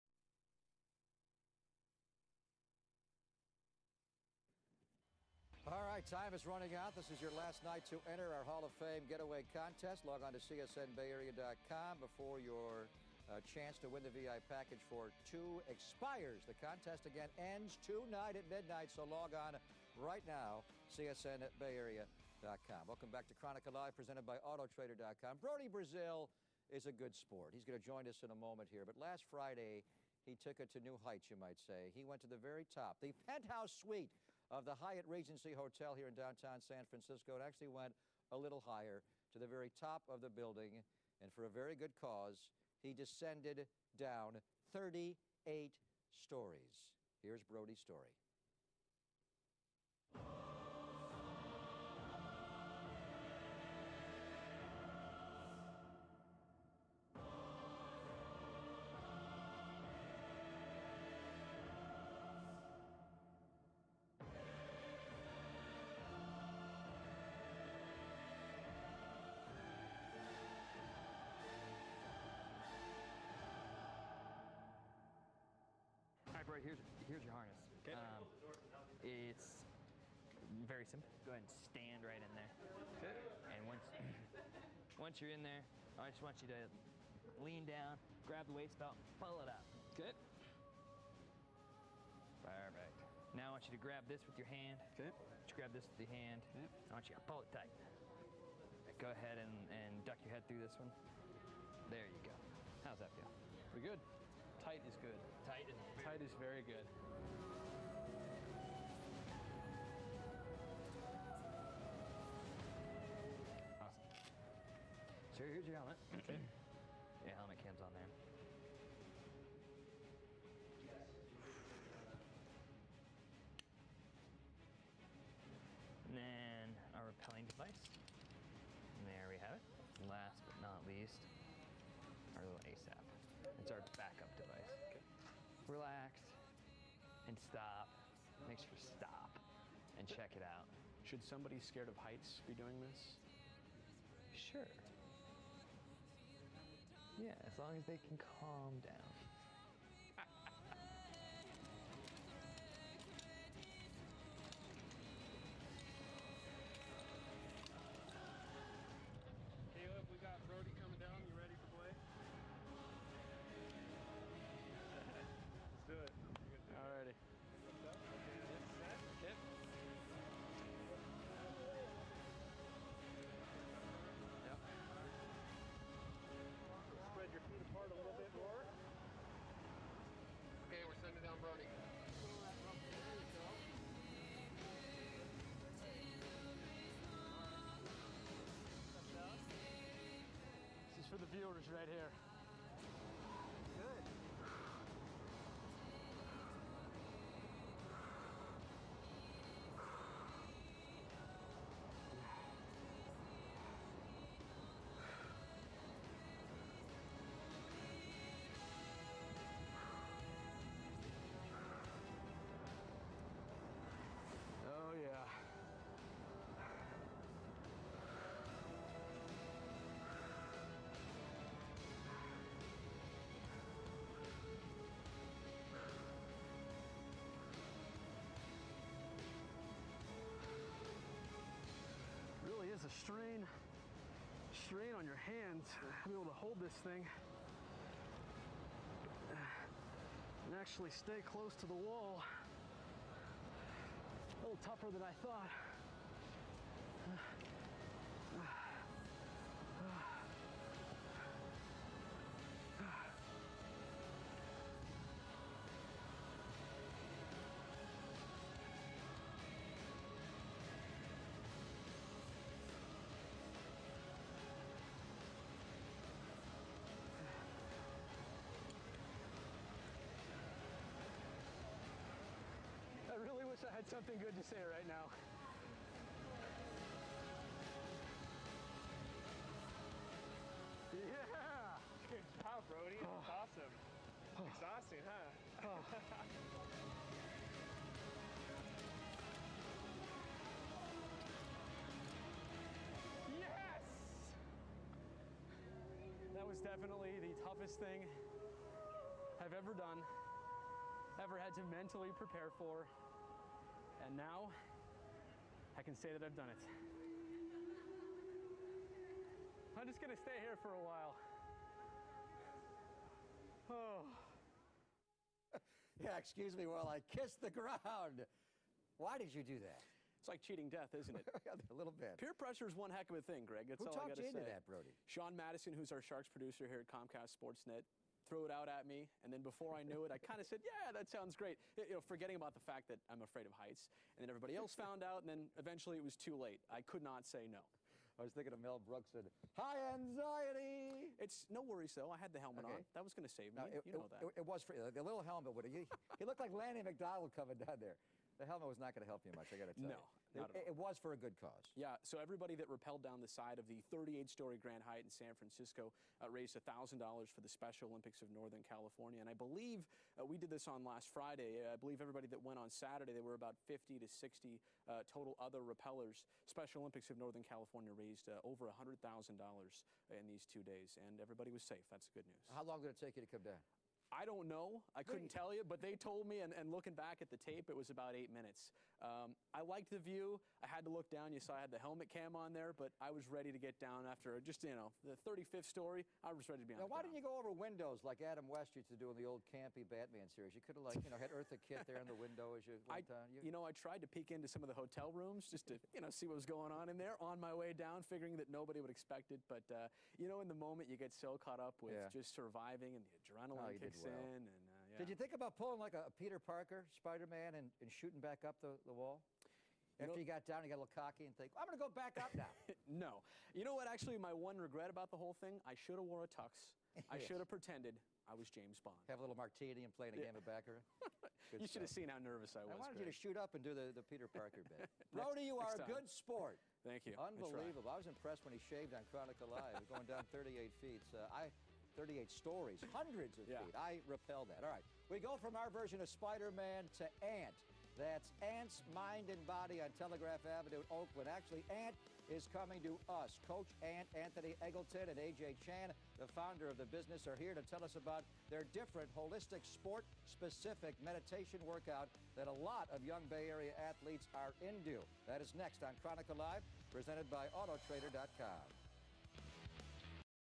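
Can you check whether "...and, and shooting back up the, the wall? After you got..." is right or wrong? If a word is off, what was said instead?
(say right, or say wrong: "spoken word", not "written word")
right.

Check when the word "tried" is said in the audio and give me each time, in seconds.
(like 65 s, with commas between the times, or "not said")
393 s.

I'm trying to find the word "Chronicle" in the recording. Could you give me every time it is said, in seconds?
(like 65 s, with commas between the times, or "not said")
23 s, 429 s, 455 s.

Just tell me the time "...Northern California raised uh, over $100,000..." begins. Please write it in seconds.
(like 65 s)
367 s.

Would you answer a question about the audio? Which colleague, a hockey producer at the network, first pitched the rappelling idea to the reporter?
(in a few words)
Sean Madison.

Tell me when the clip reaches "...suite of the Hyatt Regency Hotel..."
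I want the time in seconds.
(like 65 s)
33 s.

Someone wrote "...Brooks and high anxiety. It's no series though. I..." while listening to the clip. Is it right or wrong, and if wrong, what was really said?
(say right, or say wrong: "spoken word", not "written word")
wrong: "worries", not "series".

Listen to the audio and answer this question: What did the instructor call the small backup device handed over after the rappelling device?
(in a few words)
ASAP.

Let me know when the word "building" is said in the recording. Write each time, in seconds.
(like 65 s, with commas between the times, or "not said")
40 s.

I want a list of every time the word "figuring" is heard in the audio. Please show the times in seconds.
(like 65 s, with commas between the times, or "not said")
398 s.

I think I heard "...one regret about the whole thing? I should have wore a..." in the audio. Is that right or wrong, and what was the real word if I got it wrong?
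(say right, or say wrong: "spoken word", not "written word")
right.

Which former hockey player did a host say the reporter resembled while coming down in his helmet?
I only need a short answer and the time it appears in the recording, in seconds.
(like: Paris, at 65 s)
Lanny McDonald, at 346 s.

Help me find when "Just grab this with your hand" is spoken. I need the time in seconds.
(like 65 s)
95 s.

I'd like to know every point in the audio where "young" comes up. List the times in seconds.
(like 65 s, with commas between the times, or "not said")
453 s.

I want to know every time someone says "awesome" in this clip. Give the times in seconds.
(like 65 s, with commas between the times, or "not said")
113 s, 283 s.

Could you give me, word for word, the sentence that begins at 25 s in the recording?
Brodie Brazil is a good sport.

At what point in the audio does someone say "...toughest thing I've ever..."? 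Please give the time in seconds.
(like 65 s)
297 s.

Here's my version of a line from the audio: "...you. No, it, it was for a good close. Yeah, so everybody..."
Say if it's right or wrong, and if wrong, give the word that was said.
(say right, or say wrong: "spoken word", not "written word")
wrong: "cause", not "close".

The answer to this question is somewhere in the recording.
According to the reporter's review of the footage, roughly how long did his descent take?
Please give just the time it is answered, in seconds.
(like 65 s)
378 s.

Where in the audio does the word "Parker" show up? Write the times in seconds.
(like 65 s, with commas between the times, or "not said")
406 s, 424 s.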